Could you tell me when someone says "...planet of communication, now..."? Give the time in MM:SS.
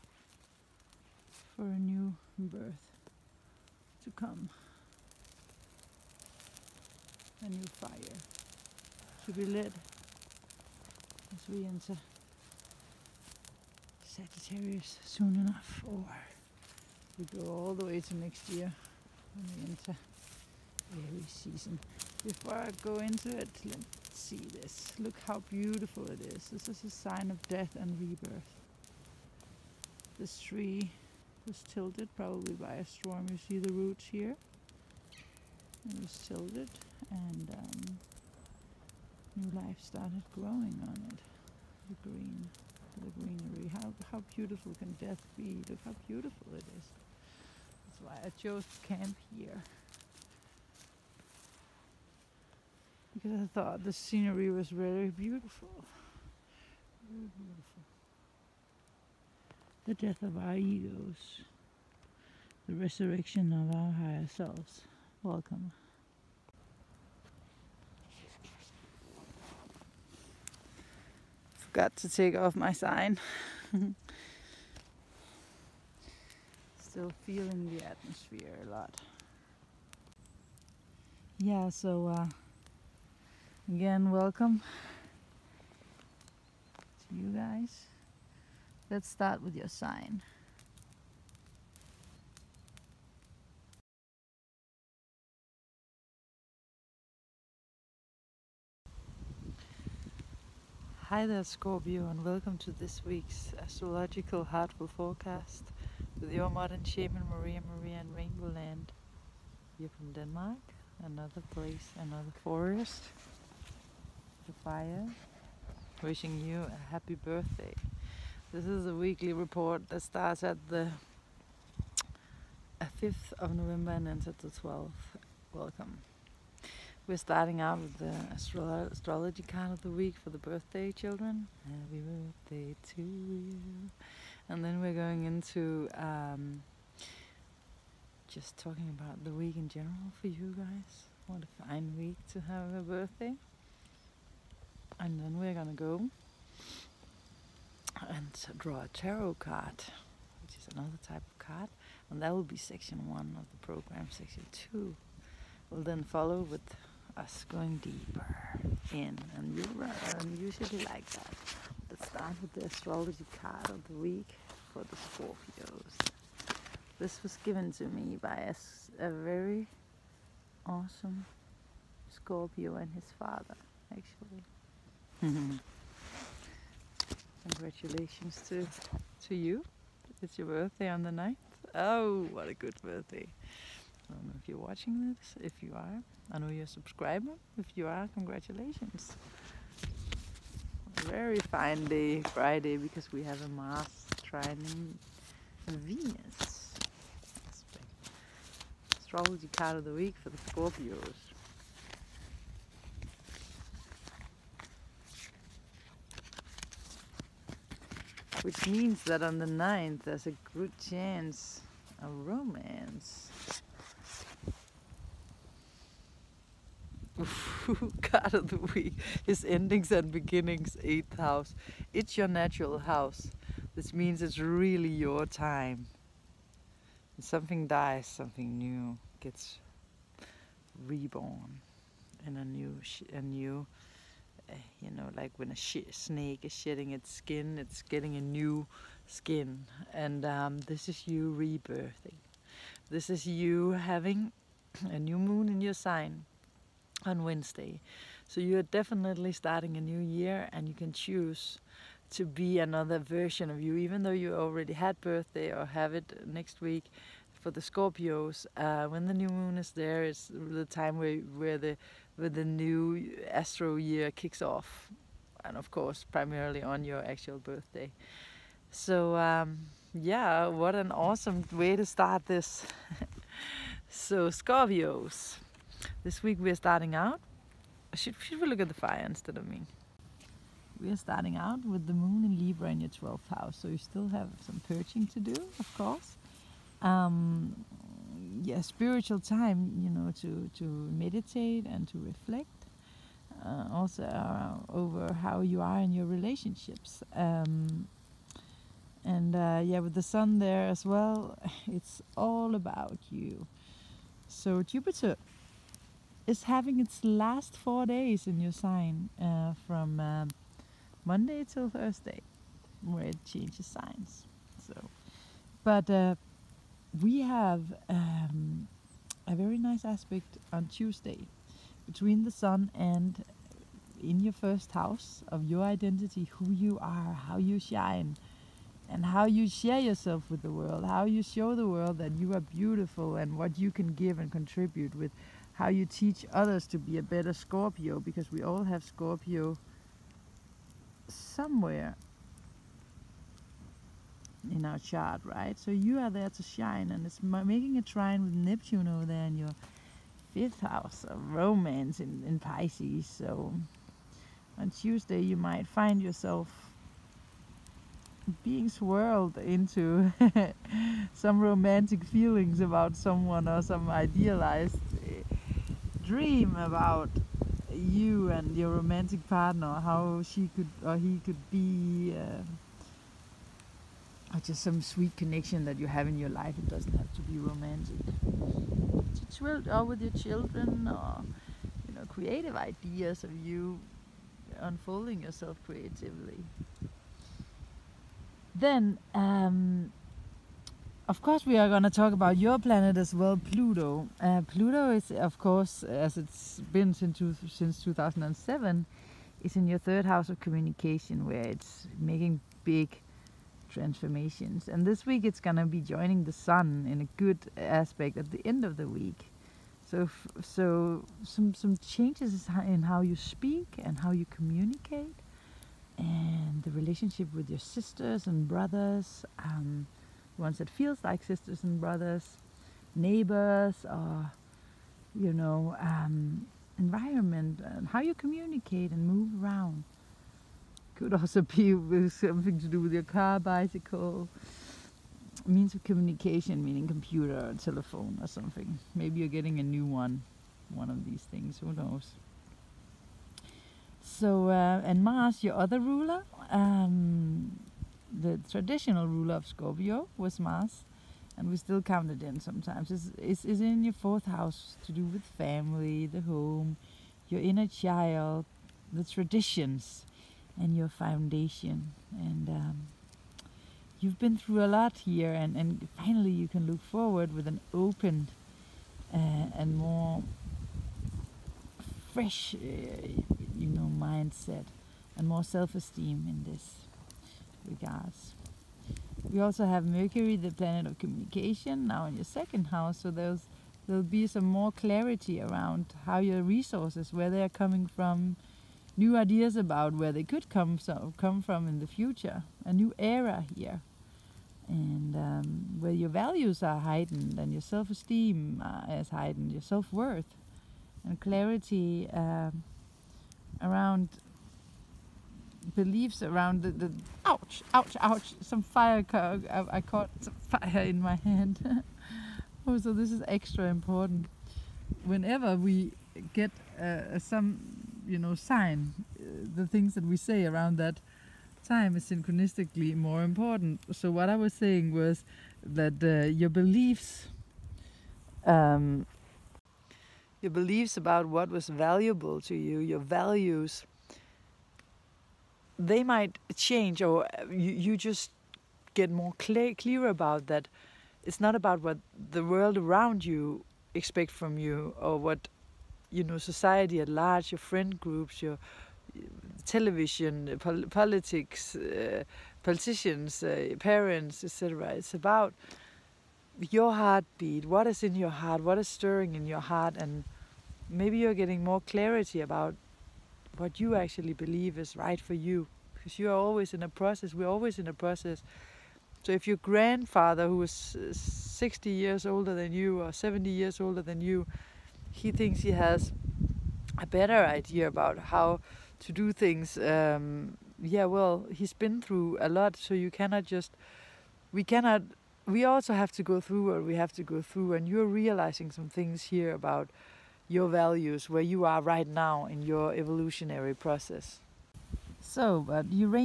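08:00.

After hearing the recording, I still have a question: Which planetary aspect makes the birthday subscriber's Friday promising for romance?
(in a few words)
Mars trining Venus.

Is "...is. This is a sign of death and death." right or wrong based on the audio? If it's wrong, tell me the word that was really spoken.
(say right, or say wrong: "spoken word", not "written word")
wrong: "rebirth", not "death".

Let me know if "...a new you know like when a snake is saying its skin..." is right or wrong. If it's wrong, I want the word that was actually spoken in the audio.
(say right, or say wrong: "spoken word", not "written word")
wrong: "shedding", not "saying".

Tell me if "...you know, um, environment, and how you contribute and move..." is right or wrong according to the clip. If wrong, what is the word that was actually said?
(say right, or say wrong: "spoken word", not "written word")
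wrong: "communicate", not "contribute".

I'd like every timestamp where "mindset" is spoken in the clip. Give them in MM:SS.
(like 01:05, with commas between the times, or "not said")
07:53.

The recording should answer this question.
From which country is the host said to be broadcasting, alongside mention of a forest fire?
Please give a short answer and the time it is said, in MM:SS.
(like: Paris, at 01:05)
Denmark, at 01:50.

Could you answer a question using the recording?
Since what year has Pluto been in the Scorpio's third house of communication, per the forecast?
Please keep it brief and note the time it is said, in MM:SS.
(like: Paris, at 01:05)
2007, at 06:37.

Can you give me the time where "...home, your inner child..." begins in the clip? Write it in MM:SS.
07:36.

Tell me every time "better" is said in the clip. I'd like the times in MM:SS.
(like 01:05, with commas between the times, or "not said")
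05:37, 09:37.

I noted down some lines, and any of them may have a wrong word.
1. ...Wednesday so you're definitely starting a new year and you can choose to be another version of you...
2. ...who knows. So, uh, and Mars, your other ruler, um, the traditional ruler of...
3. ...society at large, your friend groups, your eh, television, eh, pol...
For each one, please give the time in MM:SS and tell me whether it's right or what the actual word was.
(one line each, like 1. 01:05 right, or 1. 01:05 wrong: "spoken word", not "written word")
1. 04:07 right
2. 07:21 right
3. 09:06 right.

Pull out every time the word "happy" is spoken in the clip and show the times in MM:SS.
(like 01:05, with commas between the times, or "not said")
01:56, 02:11.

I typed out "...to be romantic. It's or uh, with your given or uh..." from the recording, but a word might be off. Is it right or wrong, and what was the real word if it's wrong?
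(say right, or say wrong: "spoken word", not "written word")
wrong: "children", not "given".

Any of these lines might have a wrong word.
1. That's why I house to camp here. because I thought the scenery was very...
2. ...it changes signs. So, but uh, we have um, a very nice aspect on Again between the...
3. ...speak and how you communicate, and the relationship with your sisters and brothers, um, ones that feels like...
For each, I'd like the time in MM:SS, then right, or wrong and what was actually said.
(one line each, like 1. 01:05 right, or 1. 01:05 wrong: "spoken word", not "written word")
1. 00:47 wrong: "chose", not "house"
2. 05:13 wrong: "Tuesday", not "Again"
3. 06:53 right.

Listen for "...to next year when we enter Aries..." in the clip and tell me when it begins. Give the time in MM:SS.
00:17.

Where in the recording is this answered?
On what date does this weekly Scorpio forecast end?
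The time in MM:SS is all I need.
02:04.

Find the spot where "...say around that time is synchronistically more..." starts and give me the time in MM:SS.
08:40.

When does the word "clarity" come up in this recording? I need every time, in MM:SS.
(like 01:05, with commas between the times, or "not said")
08:04, 08:21, 09:21.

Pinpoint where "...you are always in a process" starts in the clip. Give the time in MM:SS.
09:26.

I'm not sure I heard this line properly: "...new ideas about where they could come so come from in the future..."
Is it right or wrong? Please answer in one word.
right.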